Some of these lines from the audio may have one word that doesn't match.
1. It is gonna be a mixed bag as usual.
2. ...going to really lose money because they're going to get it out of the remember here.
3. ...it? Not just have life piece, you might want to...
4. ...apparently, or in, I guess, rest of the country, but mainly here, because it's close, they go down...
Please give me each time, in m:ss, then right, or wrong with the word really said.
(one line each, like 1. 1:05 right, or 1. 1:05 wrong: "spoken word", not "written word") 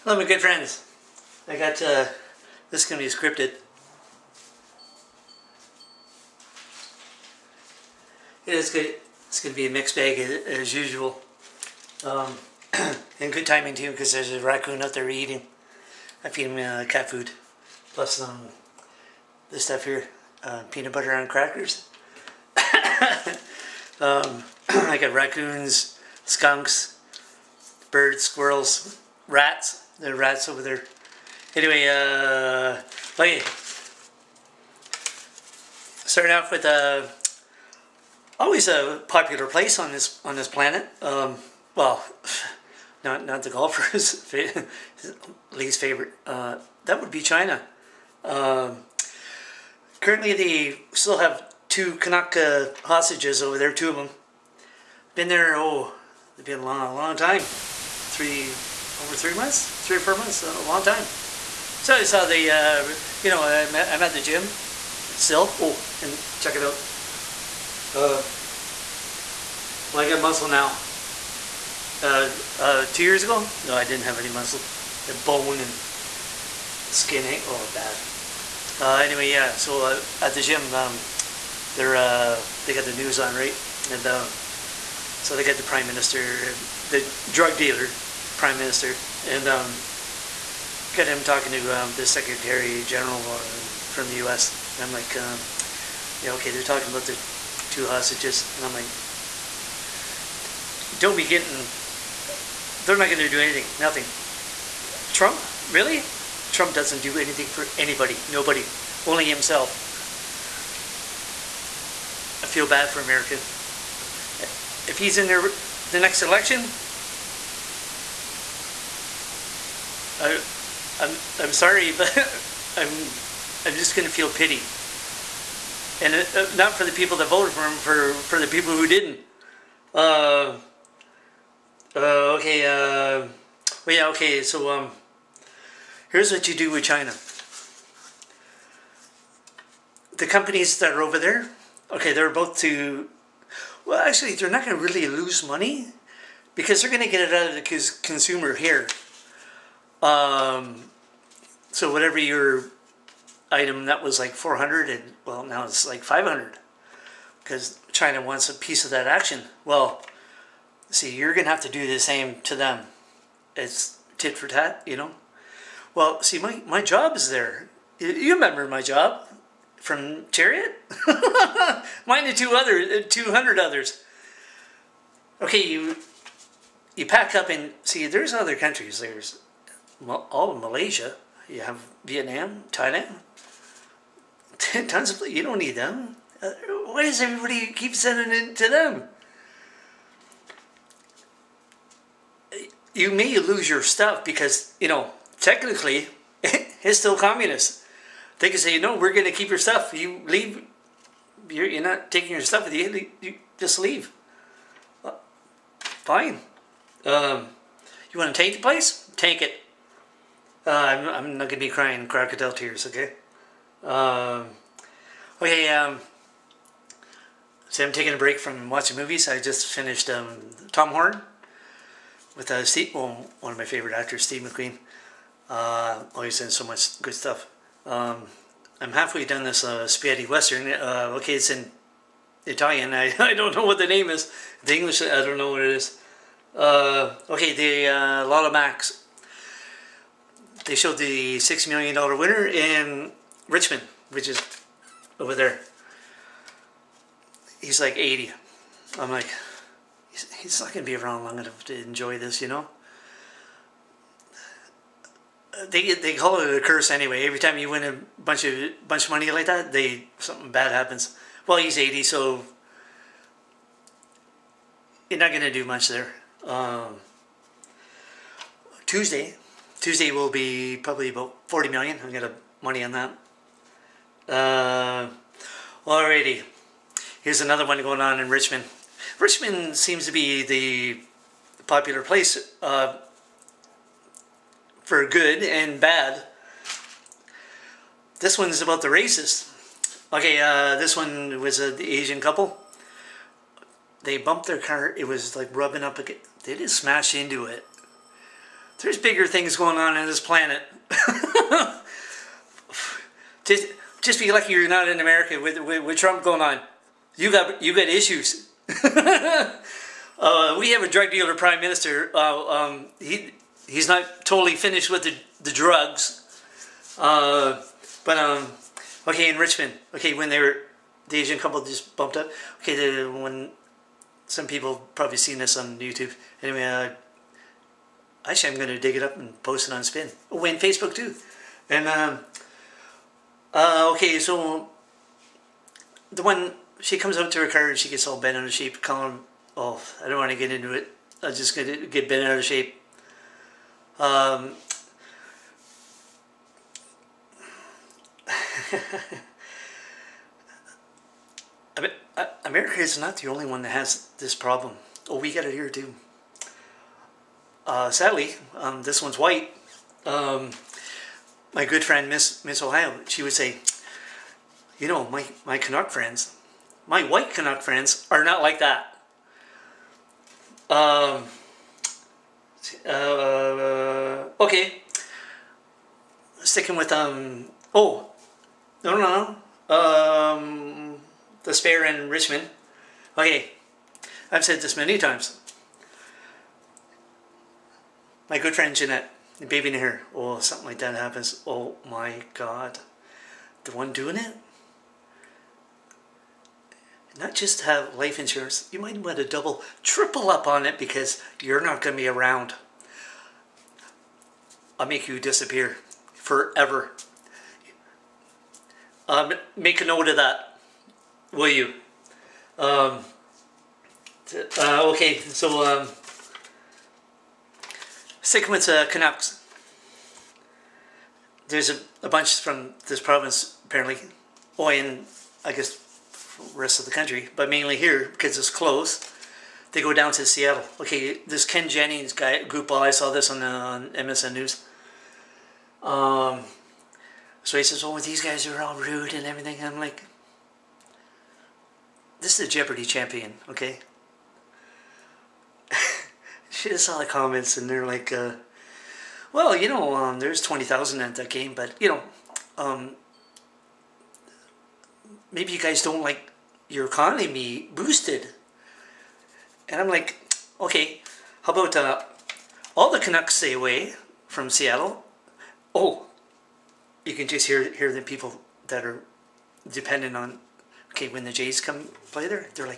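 1. 0:08 right
2. 2:24 wrong: "consumer", not "remember"
3. 6:34 wrong: "insurance", not "piece"
4. 7:03 right.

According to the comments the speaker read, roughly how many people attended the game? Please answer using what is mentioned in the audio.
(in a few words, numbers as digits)
20,000.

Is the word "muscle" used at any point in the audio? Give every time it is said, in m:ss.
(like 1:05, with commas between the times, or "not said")
1:10, 1:14.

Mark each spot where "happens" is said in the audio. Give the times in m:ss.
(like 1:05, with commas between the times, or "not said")
4:20, 6:30.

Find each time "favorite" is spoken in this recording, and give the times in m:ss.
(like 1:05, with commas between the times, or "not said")
0:45, 3:43.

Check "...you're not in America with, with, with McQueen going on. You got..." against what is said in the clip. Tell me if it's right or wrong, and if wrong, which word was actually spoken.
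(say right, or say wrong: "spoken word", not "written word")
wrong: "Trump", not "McQueen".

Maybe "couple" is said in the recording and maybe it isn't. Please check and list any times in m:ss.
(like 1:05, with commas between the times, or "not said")
4:52, 5:21.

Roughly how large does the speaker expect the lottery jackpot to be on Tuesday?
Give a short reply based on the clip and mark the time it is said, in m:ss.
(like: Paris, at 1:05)
40 million, at 4:31.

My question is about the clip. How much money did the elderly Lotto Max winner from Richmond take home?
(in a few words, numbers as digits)
$6 million.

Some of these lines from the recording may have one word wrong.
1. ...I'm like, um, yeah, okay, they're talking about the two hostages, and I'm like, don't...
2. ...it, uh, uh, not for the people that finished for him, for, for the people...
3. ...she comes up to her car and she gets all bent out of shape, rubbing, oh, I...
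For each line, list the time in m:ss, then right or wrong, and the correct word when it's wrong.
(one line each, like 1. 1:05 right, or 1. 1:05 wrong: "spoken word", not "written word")
1. 1:34 right
2. 2:06 wrong: "voted", not "finished"
3. 5:36 wrong: "calling", not "rubbing".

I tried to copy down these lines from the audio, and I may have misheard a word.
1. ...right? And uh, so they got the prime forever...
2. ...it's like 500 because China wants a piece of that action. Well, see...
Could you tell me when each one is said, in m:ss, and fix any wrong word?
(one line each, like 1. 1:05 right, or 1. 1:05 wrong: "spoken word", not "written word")
1. 1:23 wrong: "minister", not "forever"
2. 2:35 right.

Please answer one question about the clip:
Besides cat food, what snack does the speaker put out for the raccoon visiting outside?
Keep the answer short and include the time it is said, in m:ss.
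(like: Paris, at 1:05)
Peanut butter on crackers, at 0:20.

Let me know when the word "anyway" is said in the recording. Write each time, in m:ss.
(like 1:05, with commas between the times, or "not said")
0:31, 1:18, 4:16, 5:26.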